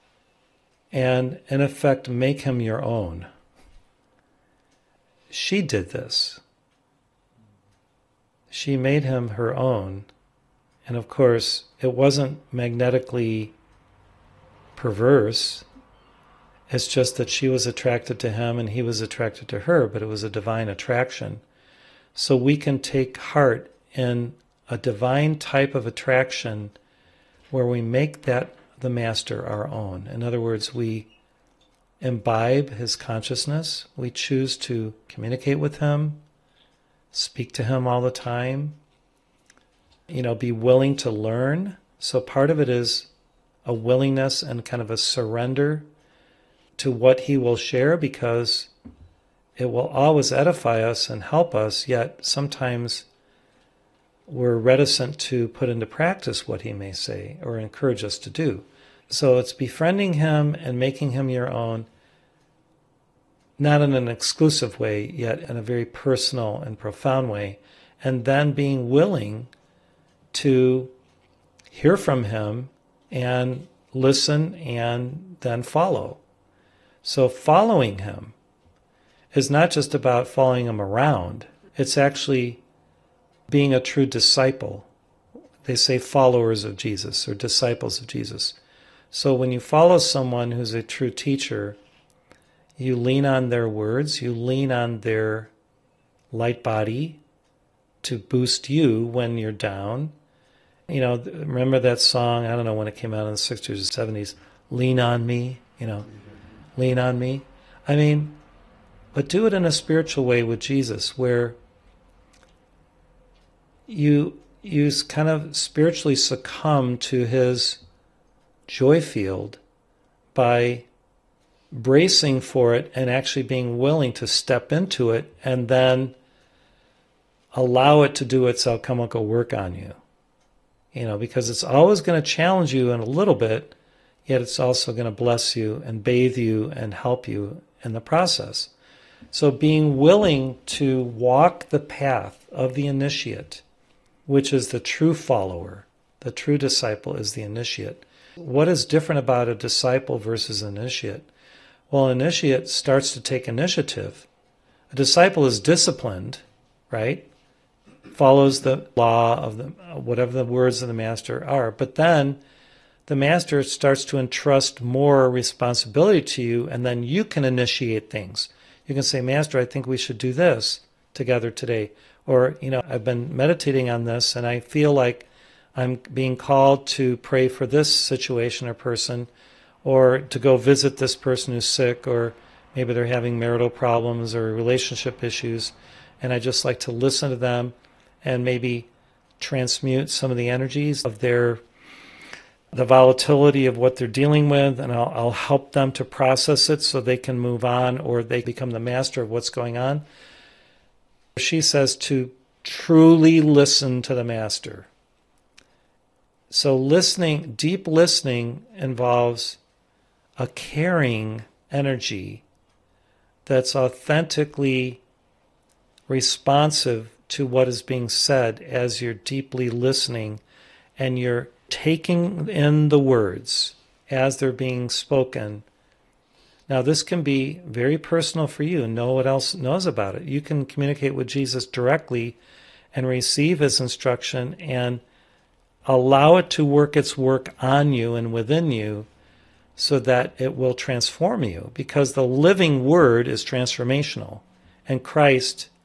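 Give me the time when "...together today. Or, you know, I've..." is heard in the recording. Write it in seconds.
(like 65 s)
171 s.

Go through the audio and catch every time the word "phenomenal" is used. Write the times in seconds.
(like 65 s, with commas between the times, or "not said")
not said.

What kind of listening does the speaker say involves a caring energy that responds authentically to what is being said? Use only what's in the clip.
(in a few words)
deep listening.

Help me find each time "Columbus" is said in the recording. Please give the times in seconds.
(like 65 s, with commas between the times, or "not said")
not said.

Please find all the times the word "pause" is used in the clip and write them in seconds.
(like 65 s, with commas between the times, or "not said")
not said.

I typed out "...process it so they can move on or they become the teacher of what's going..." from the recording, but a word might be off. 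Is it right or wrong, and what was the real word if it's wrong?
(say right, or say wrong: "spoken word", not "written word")
wrong: "master", not "teacher".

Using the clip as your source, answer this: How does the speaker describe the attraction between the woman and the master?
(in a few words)
divine attraction.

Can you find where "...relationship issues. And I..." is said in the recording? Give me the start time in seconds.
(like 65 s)
184 s.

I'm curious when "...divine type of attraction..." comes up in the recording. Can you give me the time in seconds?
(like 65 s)
24 s.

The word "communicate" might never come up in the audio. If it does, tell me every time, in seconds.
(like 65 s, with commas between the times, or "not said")
35 s, 230 s.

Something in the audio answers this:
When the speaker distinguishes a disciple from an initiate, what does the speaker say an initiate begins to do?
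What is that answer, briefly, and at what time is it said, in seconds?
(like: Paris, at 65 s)
take initiative, at 153 s.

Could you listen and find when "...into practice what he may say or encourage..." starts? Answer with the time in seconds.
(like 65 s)
55 s.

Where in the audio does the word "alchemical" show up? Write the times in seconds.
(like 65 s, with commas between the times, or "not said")
128 s.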